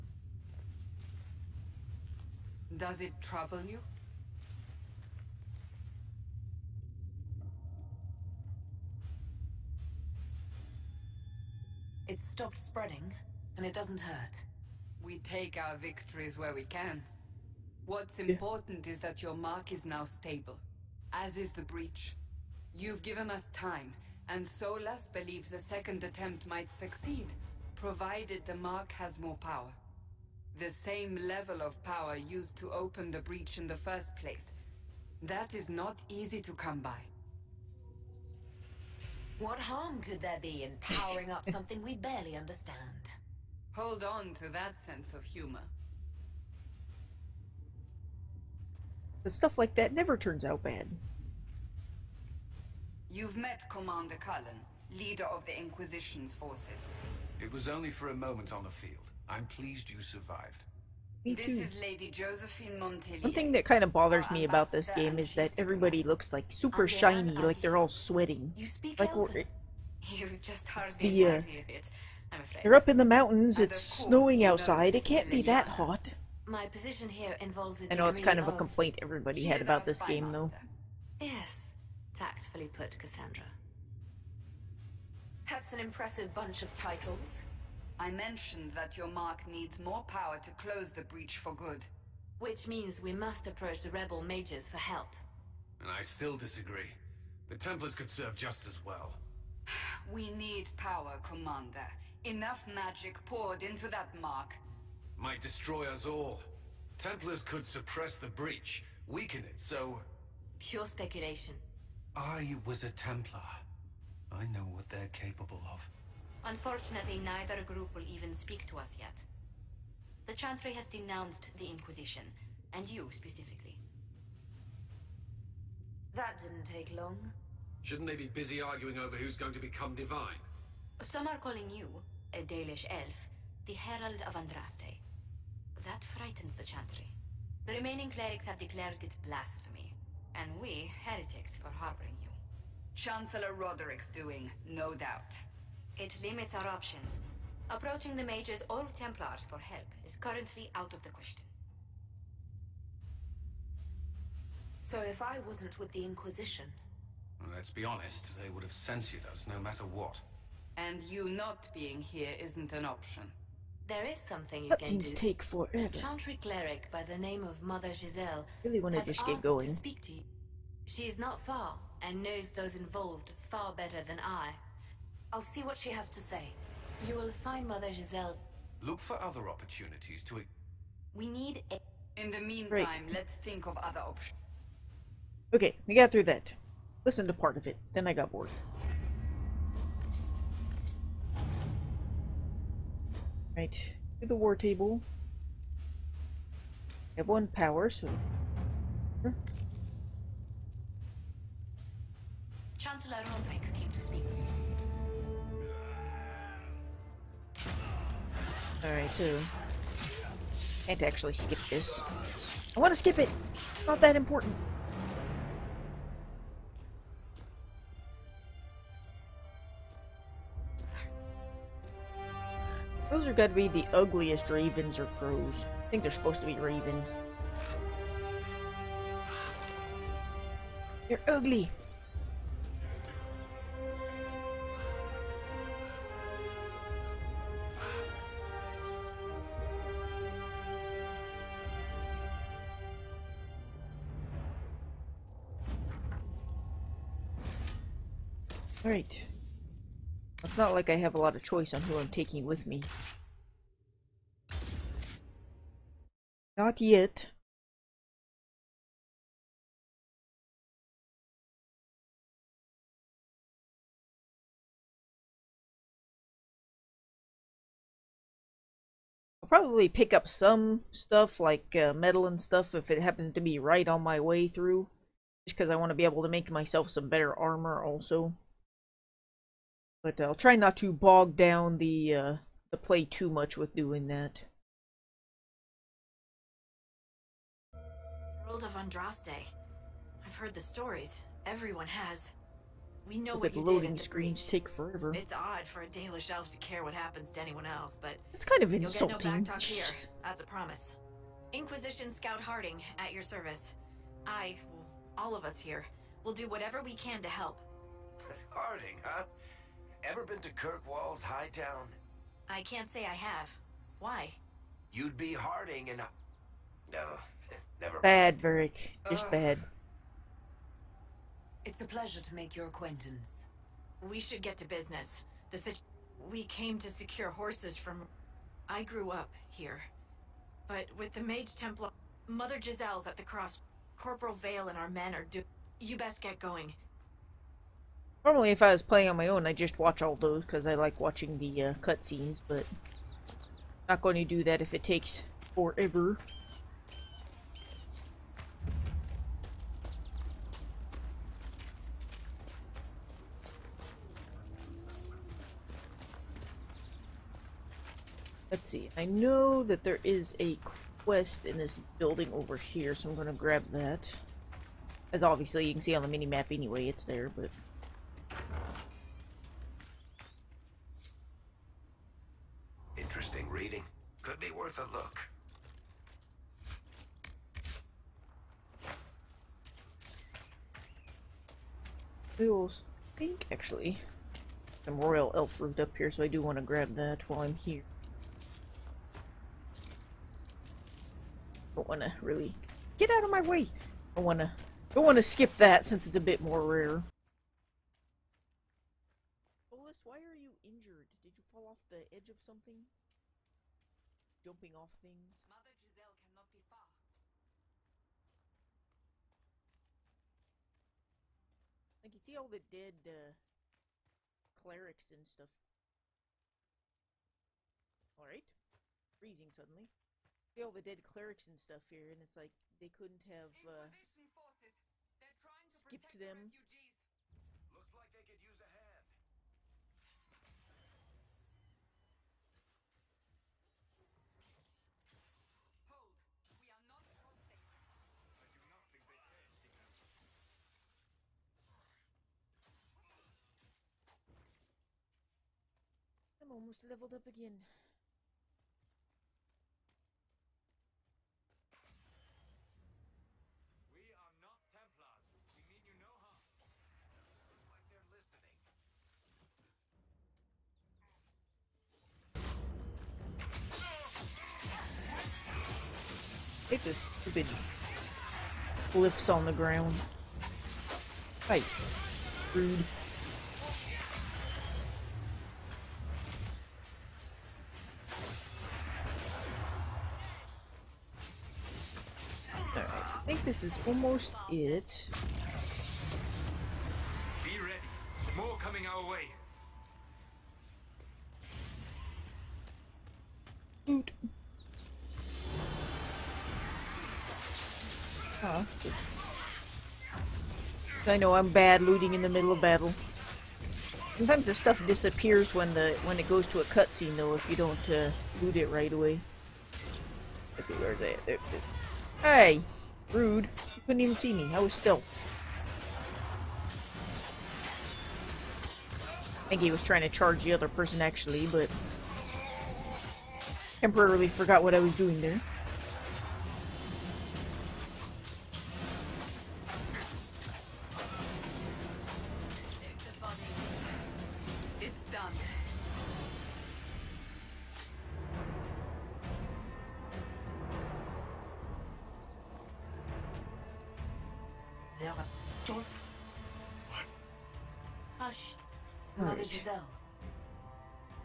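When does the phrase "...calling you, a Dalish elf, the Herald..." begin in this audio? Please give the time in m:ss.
2:11.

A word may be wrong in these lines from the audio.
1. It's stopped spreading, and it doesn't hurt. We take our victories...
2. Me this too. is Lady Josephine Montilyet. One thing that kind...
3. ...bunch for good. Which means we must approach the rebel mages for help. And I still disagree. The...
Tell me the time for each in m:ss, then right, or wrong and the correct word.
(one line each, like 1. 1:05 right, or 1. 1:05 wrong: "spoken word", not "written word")
1. 0:12 right
2. 1:01 right
3. 1:31 wrong: "breach", not "bunch".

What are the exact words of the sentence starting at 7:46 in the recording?
It just stupid glyphs on the ground.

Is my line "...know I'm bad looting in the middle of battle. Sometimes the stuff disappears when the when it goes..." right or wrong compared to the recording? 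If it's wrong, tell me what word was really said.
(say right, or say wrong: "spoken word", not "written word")
right.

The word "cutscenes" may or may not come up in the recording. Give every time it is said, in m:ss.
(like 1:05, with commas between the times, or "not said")
5:41, 8:26.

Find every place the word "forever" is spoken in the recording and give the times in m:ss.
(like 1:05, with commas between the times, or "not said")
2:45, 4:54, 5:45.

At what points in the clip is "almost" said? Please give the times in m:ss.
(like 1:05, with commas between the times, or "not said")
7:26, 8:03.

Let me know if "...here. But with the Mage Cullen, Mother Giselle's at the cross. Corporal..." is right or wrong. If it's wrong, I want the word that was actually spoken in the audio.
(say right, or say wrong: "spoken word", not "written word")
wrong: "Templar", not "Cullen".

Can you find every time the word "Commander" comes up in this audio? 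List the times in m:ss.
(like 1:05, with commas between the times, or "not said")
0:53, 1:41.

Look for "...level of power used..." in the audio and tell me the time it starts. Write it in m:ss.
0:31.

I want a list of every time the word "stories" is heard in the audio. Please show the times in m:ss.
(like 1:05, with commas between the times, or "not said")
4:50.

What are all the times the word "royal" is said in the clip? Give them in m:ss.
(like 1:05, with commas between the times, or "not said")
6:24.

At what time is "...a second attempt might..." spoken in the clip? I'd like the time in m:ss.
0:25.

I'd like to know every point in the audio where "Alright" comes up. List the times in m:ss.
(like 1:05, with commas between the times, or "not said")
3:28, 4:08, 6:58.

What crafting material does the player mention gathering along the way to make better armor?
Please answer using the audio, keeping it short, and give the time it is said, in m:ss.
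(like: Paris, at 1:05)
metal, at 4:31.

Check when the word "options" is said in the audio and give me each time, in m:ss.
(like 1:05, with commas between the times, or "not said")
2:26, 2:42, 3:04.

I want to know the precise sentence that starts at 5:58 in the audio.
Let's see, I know that there is a quest in this building over here, so I'm going to grab that.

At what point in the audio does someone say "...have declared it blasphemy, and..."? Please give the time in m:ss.
2:18.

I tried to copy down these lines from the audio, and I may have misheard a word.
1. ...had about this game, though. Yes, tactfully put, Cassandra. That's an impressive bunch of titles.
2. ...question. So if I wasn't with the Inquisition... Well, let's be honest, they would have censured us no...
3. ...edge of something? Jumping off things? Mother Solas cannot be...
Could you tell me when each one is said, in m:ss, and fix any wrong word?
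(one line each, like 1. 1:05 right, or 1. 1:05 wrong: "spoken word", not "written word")
1. 1:19 right
2. 2:31 right
3. 6:42 wrong: "Giselle", not "Solas".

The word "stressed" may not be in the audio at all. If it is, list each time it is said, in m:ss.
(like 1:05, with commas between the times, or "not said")
not said.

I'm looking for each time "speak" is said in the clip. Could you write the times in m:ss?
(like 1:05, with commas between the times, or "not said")
1:08, 1:58, 2:49.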